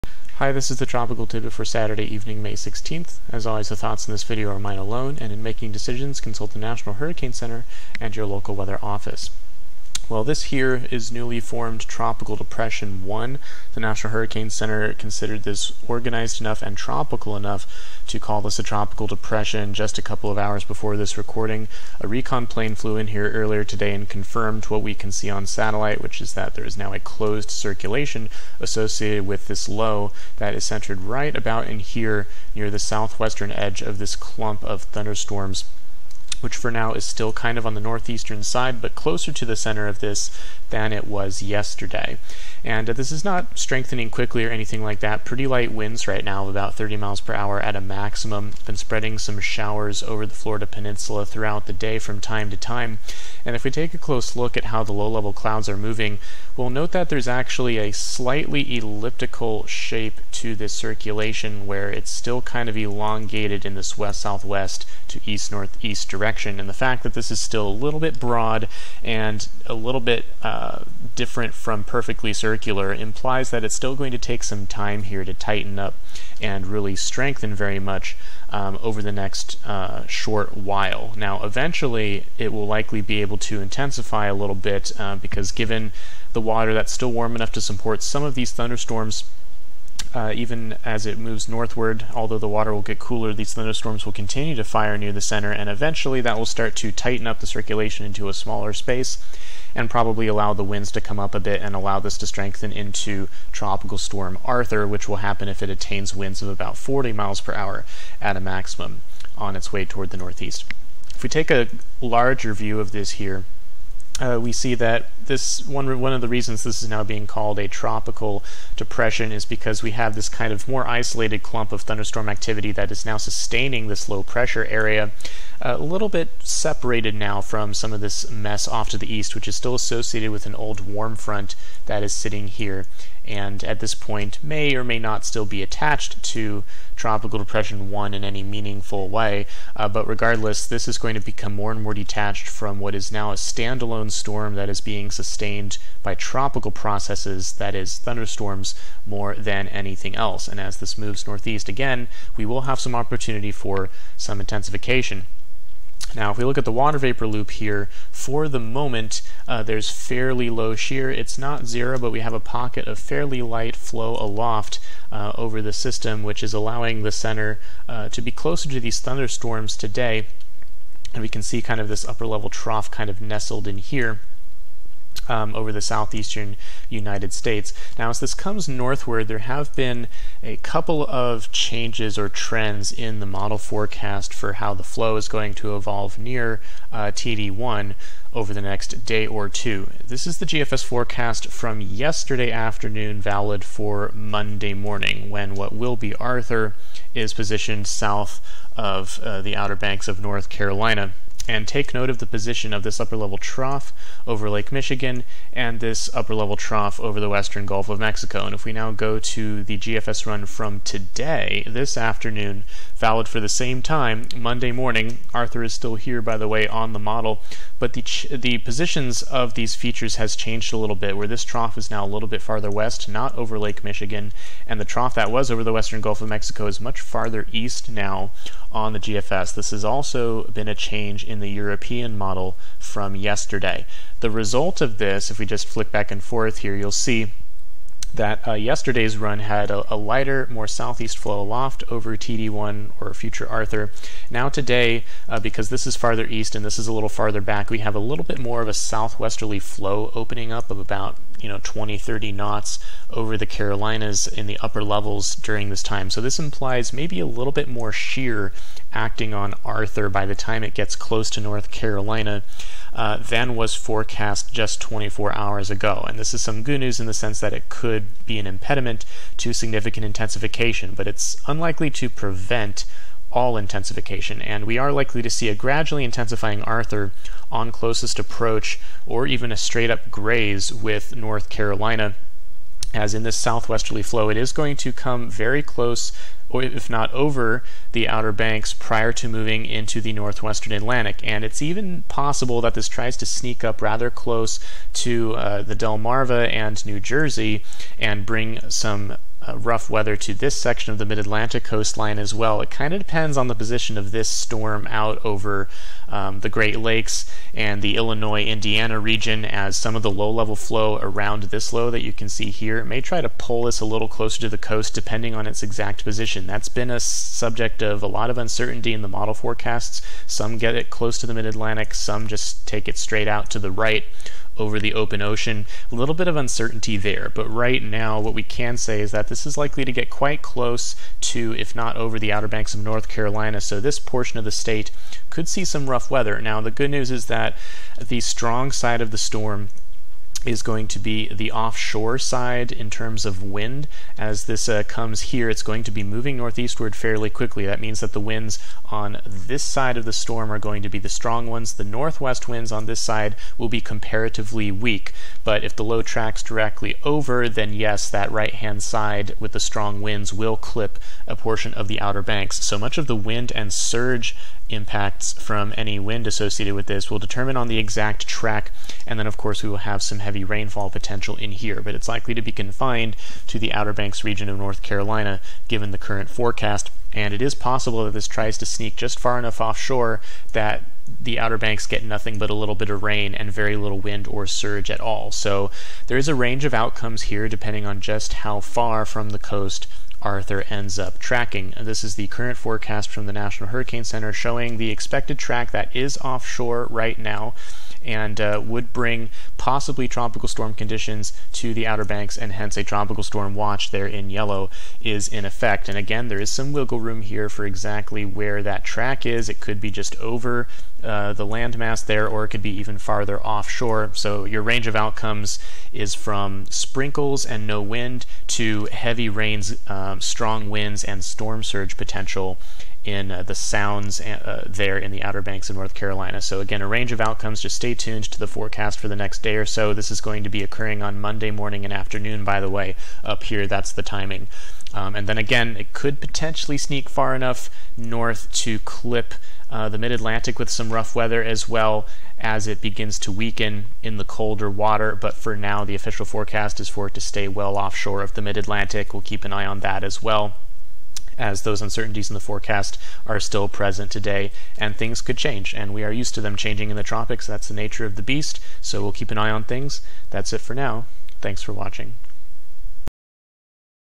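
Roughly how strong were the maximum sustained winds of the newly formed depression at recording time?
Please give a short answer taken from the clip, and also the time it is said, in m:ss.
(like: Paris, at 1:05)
30 miles per hour, at 0:46.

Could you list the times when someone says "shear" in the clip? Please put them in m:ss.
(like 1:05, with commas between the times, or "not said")
2:40, 4:17.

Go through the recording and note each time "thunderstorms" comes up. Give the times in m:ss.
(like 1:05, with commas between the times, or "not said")
0:34, 1:28, 1:33, 2:01, 2:27, 2:48.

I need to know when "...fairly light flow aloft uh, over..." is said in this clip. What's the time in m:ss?
2:42.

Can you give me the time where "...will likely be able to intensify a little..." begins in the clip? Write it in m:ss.
1:22.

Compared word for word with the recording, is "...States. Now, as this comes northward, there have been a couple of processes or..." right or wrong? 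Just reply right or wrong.
wrong.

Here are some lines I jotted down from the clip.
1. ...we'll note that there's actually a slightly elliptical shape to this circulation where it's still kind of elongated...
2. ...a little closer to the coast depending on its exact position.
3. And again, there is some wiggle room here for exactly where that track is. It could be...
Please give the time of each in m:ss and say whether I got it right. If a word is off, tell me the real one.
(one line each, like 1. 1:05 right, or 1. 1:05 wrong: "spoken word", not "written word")
1. 0:56 right
2. 5:13 right
3. 6:45 right.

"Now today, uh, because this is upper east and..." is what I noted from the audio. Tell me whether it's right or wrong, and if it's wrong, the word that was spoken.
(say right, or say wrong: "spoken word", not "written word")
wrong: "farther", not "upper".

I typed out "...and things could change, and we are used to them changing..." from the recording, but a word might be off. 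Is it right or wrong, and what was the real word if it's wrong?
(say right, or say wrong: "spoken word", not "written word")
right.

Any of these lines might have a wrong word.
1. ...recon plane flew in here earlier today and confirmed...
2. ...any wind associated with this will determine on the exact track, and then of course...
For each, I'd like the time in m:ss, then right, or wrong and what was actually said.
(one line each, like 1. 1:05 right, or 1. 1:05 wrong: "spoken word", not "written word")
1. 0:22 right
2. 6:05 right.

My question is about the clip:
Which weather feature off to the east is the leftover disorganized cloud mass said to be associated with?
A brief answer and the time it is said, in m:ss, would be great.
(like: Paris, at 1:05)
Old warm front, at 2:10.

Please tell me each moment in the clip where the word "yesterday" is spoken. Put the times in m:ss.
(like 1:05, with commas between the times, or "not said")
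0:41, 3:11, 3:53, 3:58.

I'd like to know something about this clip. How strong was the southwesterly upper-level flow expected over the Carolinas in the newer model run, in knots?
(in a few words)
20 to 30 knots.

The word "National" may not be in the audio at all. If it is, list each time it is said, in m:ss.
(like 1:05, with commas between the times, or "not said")
0:06, 0:13, 6:33.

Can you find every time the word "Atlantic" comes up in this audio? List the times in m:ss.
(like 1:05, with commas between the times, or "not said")
4:50, 5:01, 5:21, 7:20, 7:28.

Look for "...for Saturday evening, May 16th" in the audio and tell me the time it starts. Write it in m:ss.
0:01.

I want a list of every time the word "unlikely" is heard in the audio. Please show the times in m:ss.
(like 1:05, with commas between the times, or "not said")
4:31.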